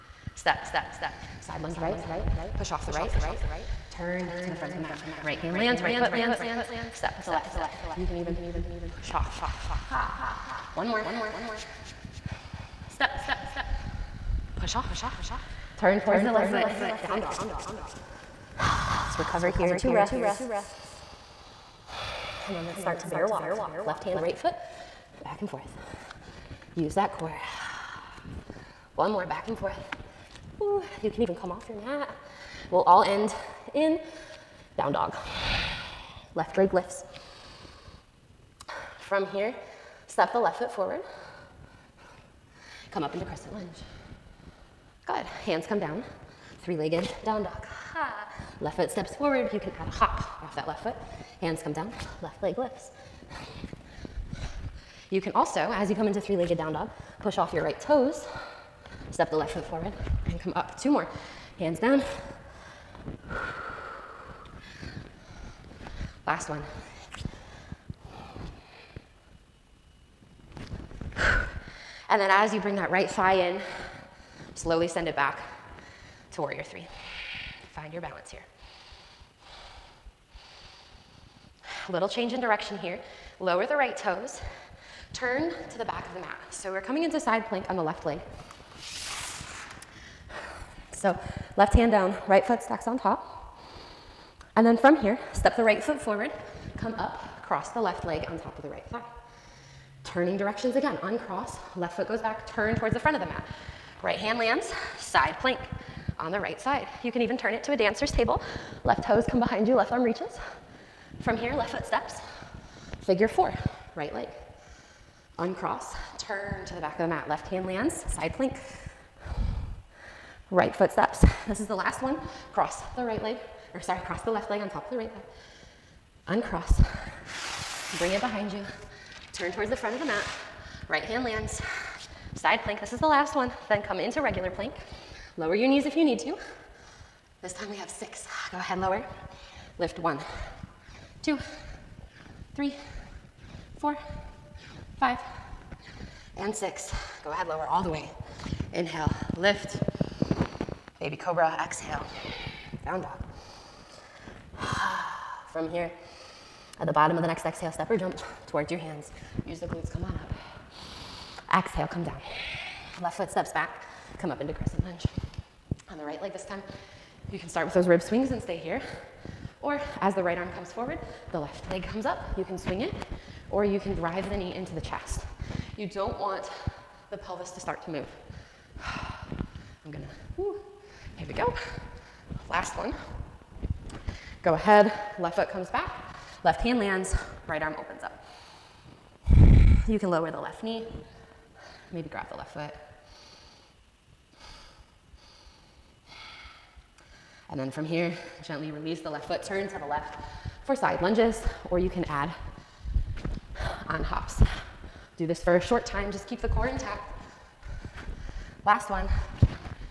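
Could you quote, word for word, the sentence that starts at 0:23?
Left hand, right foot, back and forth.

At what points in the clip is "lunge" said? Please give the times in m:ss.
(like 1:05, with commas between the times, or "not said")
0:01, 0:43, 2:44, 3:21.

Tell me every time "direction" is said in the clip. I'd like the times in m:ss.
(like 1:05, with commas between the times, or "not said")
1:22, 1:40.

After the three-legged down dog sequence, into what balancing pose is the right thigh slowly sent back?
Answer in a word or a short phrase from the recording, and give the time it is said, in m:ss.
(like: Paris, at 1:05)
Warrior three, at 1:16.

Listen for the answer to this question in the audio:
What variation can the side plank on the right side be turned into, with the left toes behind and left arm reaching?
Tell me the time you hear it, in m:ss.
1:47.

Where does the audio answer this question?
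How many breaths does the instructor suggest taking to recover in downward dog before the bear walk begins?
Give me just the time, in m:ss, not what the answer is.
0:19.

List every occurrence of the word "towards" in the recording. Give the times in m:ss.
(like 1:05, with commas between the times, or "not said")
0:16, 1:42, 2:09, 2:38.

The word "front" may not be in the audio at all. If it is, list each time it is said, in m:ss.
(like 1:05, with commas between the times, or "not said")
0:04, 1:42, 2:09.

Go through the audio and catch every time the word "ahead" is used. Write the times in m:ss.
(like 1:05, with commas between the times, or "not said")
2:18, 2:27, 3:04.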